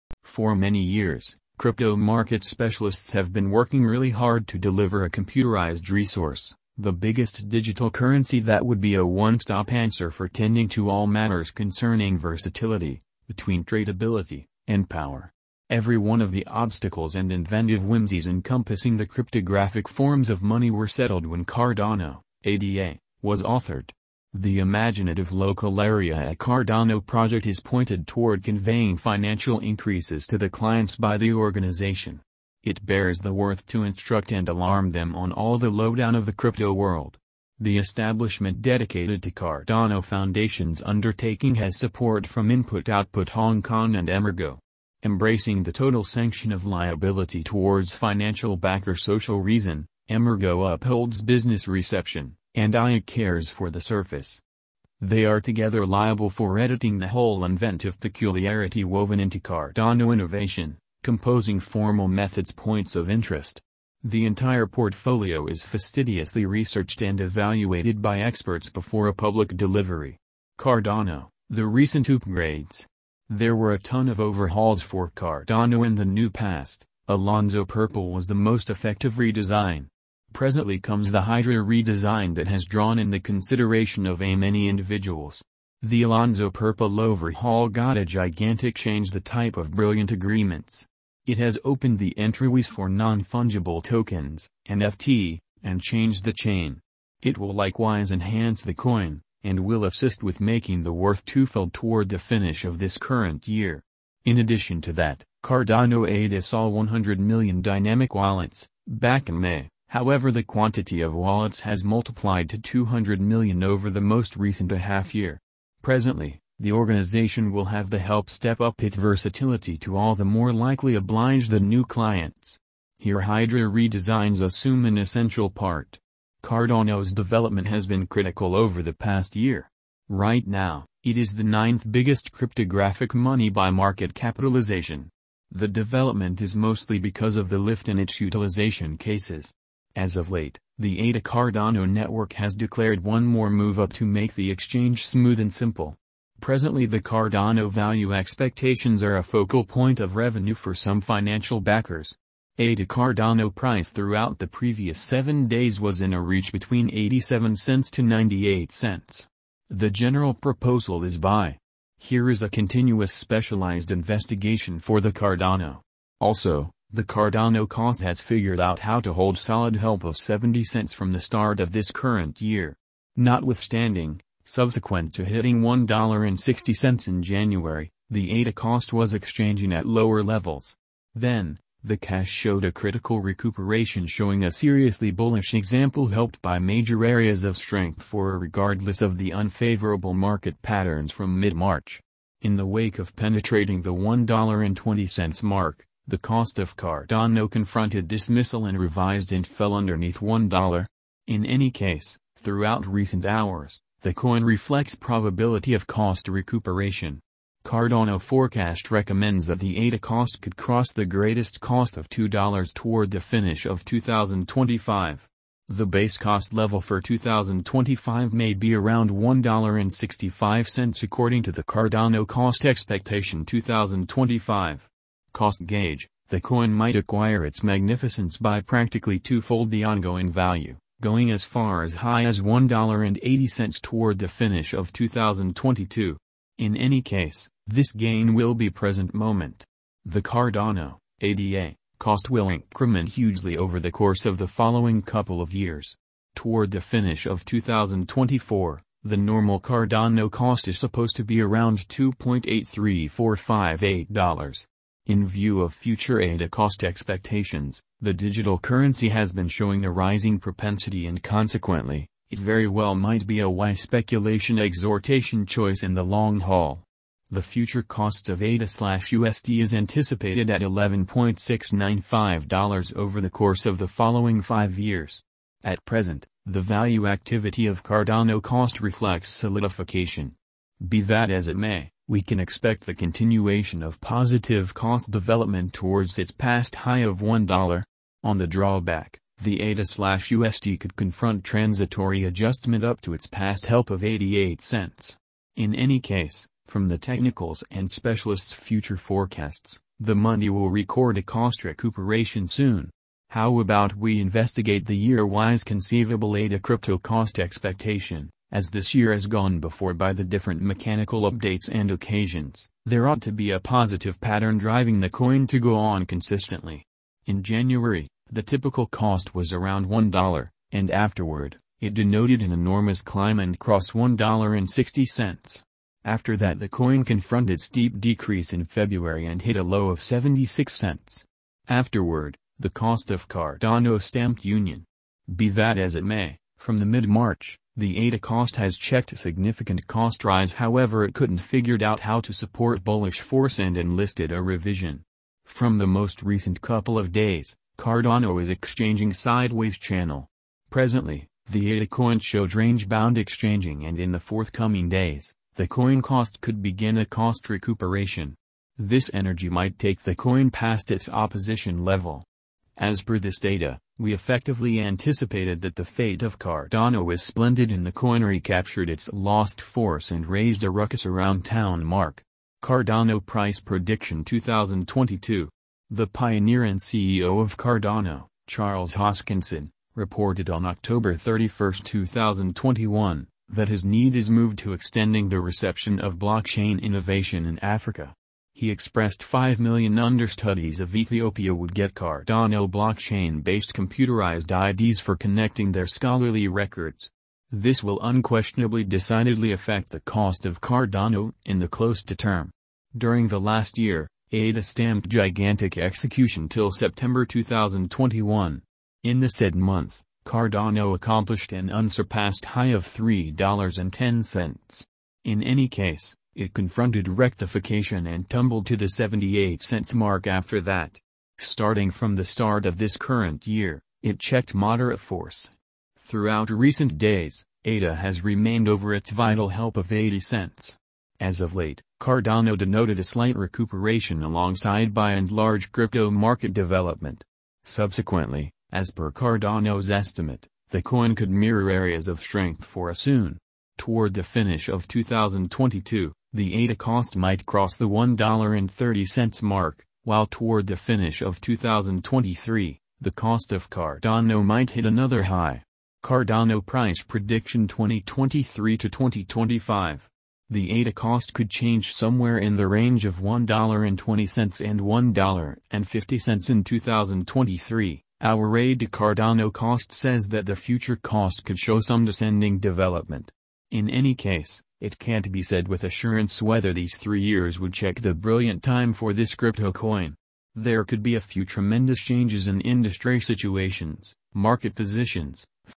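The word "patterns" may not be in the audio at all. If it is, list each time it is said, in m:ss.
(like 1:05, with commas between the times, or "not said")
3:10, 5:14.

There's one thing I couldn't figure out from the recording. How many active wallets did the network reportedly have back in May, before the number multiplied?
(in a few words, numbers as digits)
100 million.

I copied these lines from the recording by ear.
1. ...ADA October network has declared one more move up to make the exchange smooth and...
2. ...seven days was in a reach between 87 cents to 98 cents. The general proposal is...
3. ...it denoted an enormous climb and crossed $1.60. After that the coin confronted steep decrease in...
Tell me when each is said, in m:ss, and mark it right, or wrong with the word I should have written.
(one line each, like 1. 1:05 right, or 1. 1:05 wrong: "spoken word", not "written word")
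1. 2:21 wrong: "Cardano", not "October"
2. 2:34 right
3. 5:21 right.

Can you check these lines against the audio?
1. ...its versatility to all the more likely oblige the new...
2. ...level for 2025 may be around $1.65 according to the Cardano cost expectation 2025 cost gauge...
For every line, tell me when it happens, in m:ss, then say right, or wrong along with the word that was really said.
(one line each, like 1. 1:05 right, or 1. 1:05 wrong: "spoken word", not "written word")
1. 1:58 right
2. 3:36 right.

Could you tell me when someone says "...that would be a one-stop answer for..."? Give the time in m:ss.
0:08.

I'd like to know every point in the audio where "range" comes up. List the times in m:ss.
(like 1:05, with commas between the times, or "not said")
5:52, 7:42.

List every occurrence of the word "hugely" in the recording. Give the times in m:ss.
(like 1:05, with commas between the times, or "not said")
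4:03.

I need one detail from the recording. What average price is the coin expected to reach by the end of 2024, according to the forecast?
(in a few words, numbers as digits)
$2.83458.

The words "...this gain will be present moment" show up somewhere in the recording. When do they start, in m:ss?
3:57.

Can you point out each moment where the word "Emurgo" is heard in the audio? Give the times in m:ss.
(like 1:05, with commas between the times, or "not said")
0:44, 0:50.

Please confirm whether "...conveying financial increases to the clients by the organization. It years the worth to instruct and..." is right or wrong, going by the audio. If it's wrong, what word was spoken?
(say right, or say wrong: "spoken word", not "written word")
wrong: "bears", not "years".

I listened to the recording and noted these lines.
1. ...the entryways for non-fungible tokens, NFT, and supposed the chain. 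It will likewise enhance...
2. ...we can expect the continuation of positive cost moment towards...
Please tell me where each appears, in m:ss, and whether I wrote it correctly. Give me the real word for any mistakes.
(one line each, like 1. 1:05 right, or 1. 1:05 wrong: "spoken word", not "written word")
1. 1:31 wrong: "changed", not "supposed"
2. 4:42 wrong: "development", not "moment".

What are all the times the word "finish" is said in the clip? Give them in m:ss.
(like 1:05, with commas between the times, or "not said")
1:42, 3:33, 3:54, 4:06, 7:24, 7:30.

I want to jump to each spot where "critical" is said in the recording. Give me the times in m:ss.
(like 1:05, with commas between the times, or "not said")
2:08, 3:02.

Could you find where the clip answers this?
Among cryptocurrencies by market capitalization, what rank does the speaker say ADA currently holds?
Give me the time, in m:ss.
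2:11.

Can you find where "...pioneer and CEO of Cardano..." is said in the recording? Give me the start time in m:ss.
6:16.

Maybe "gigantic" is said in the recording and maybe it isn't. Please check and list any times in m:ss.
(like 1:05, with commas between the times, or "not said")
1:28, 6:45.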